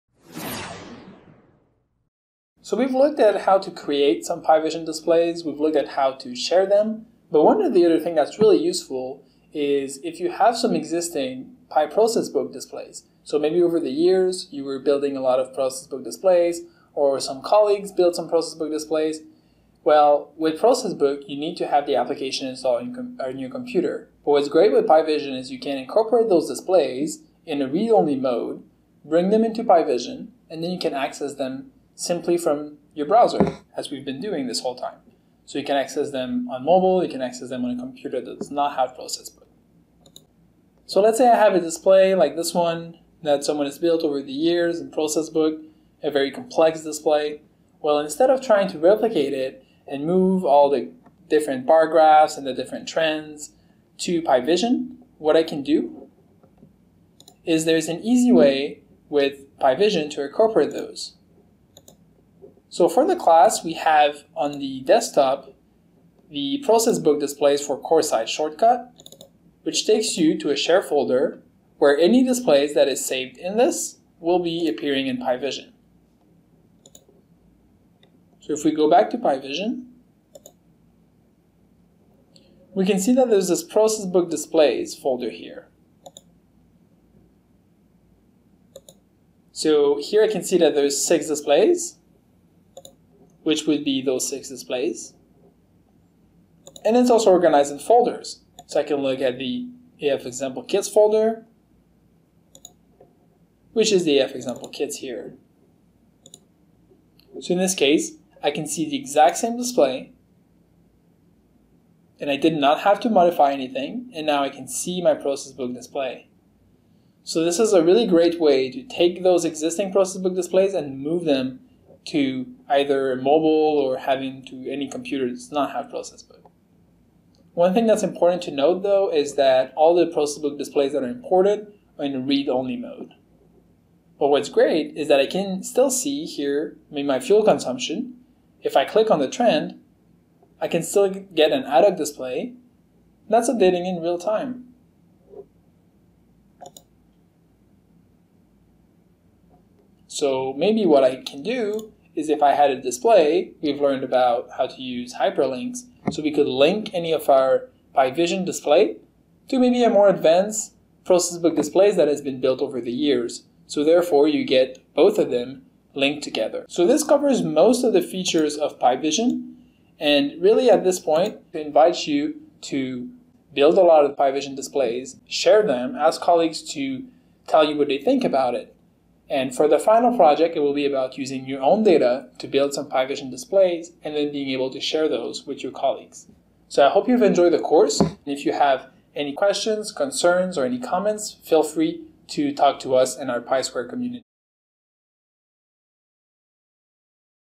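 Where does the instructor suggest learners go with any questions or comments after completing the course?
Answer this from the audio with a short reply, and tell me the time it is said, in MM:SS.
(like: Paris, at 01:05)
PI Square community, at 03:13.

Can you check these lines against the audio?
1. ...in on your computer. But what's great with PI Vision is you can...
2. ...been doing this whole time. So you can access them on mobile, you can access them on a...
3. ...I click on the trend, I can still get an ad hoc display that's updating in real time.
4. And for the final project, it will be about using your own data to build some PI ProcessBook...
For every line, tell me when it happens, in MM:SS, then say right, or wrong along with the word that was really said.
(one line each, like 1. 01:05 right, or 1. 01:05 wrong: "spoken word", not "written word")
1. 00:22 right
2. 00:34 right
3. 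02:18 right
4. 02:59 wrong: "Vision", not "ProcessBook".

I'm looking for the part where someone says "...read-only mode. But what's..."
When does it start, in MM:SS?
02:12.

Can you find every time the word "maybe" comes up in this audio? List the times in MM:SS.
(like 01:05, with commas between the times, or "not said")
00:13, 02:30, 02:39.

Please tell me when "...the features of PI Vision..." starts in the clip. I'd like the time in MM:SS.
02:47.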